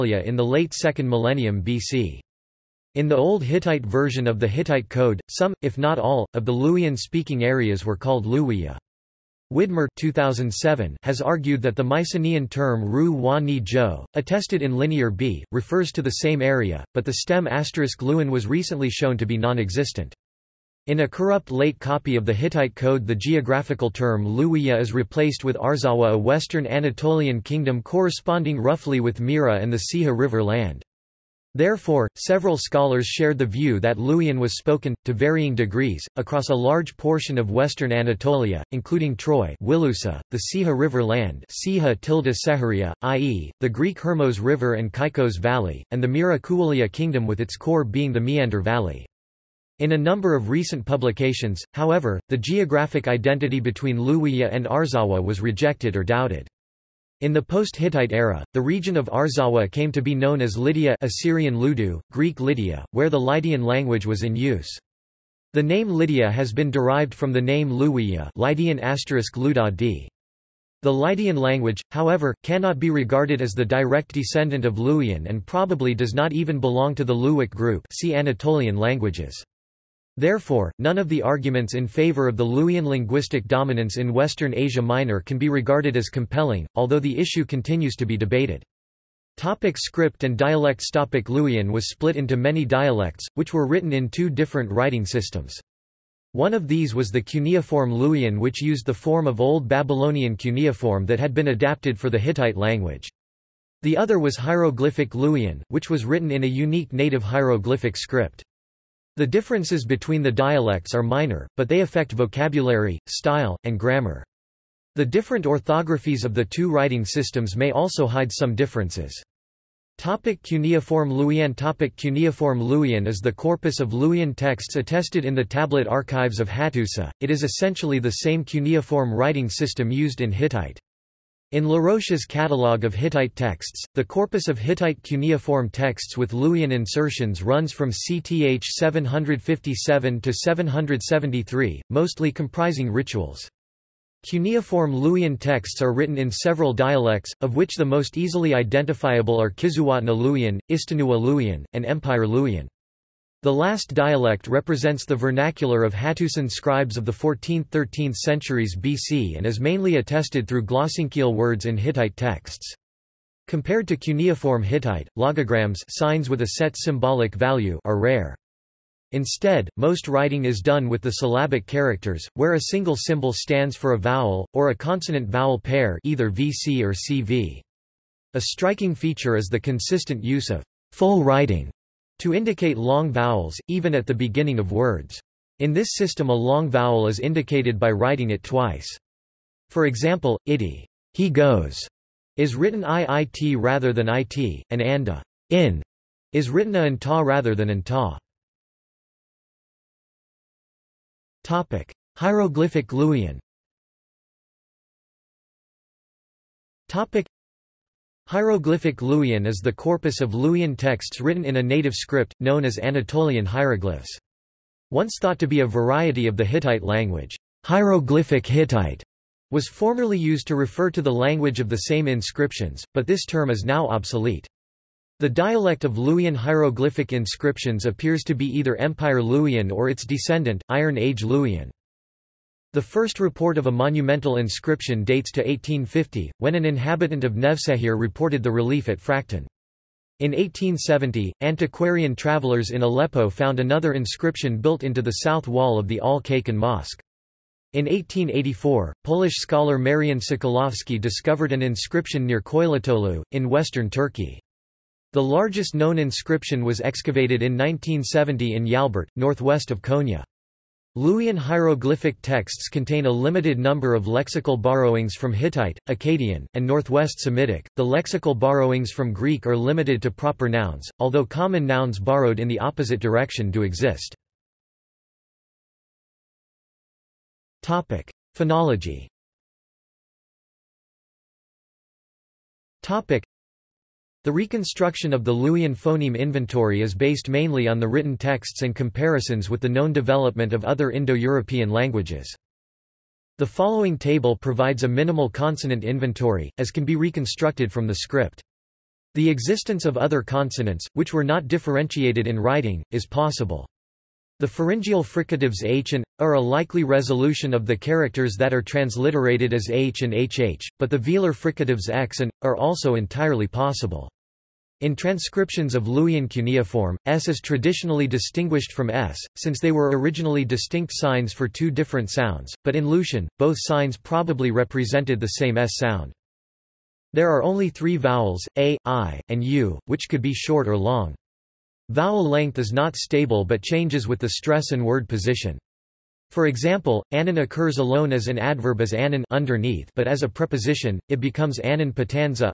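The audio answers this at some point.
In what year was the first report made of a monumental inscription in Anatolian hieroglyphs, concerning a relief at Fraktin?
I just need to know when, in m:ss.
3:55.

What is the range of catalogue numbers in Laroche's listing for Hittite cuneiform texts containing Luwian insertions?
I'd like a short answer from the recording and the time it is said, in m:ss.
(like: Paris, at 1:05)
CTH 757 to 773, at 2:17.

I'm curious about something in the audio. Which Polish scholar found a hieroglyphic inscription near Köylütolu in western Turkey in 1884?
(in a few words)
Marian Sokolowski.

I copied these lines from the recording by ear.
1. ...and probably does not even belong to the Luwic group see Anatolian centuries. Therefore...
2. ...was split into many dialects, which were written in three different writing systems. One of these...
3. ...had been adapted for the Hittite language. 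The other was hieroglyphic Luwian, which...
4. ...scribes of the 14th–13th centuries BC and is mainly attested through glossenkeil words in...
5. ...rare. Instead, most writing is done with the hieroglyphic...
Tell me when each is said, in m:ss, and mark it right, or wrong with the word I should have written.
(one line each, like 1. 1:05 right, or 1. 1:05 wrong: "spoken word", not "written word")
1. 1:15 wrong: "languages", not "centuries"
2. 1:31 wrong: "two", not "three"
3. 1:41 right
4. 2:36 right
5. 2:47 wrong: "syllabic", not "hieroglyphic".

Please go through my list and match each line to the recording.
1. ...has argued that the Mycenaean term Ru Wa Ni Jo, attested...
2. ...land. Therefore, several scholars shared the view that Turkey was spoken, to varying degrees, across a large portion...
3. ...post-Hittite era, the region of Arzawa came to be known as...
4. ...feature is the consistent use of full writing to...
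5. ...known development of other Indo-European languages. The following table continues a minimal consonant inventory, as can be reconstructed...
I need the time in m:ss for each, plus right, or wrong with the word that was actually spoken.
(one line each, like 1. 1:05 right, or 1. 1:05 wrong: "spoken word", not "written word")
1. 0:11 right
2. 0:30 wrong: "Luwian", not "Turkey"
3. 0:57 right
4. 2:58 right
5. 4:49 wrong: "provides", not "continues".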